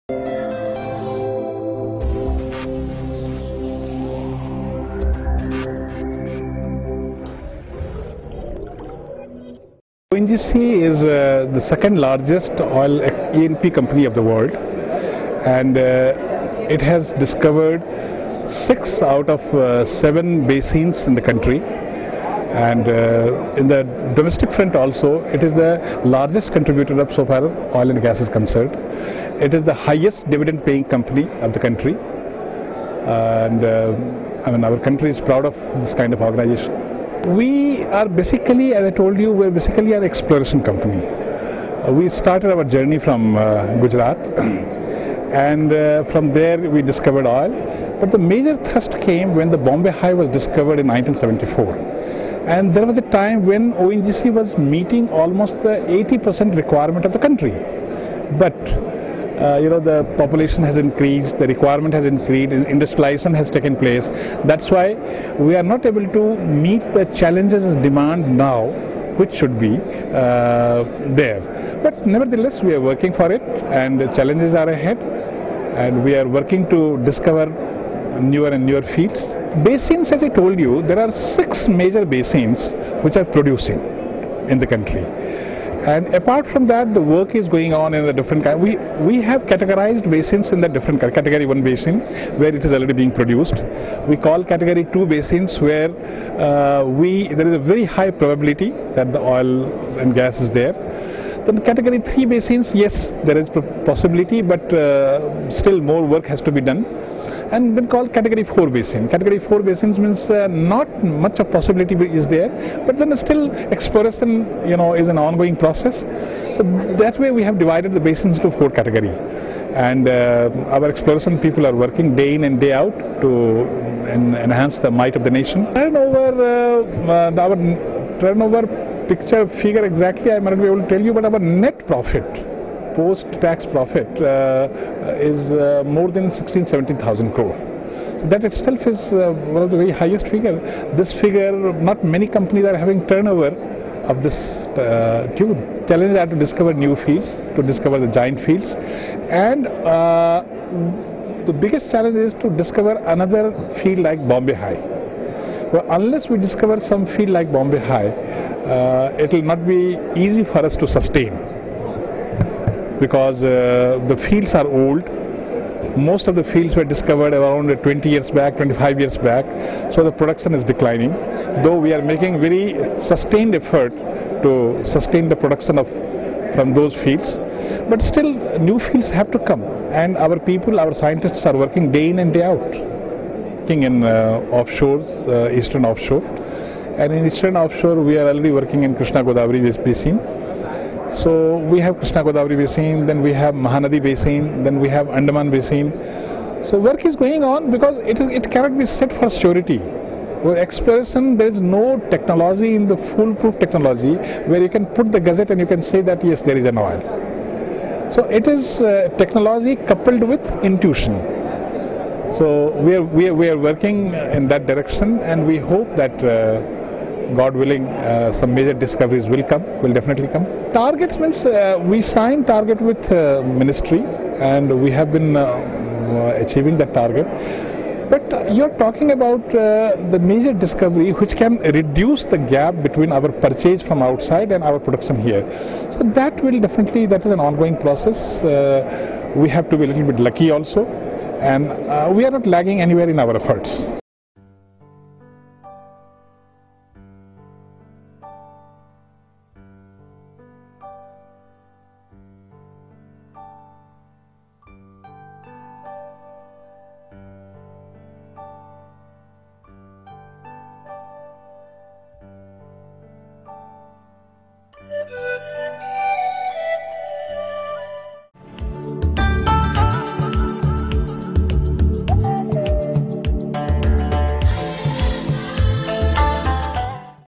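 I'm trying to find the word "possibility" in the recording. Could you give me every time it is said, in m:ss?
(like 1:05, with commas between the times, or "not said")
1:43, 1:51.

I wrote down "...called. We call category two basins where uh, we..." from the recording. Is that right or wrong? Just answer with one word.
wrong.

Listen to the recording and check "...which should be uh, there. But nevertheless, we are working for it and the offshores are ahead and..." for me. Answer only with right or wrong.
wrong.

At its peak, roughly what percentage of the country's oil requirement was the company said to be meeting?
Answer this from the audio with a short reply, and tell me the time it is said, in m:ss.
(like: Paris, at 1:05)
80%, at 0:55.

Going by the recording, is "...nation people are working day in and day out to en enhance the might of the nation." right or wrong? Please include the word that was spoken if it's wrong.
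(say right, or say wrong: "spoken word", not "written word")
wrong: "exploration", not "nation".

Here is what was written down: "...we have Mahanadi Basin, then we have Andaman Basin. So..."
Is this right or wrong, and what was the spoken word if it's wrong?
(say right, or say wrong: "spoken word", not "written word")
right.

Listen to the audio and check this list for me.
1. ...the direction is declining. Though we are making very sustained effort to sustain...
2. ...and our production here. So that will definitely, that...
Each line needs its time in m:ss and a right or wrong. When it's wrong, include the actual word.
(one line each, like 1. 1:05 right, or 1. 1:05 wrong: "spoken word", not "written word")
1. 2:50 wrong: "production", not "direction"
2. 3:54 right.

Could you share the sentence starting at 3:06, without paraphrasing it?
And in eastern offshore, we are already working in Krishna Godavari Basin.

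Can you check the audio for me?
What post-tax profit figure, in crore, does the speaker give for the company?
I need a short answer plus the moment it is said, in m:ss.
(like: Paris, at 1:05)
More than 16,000-17,000 crore, at 2:16.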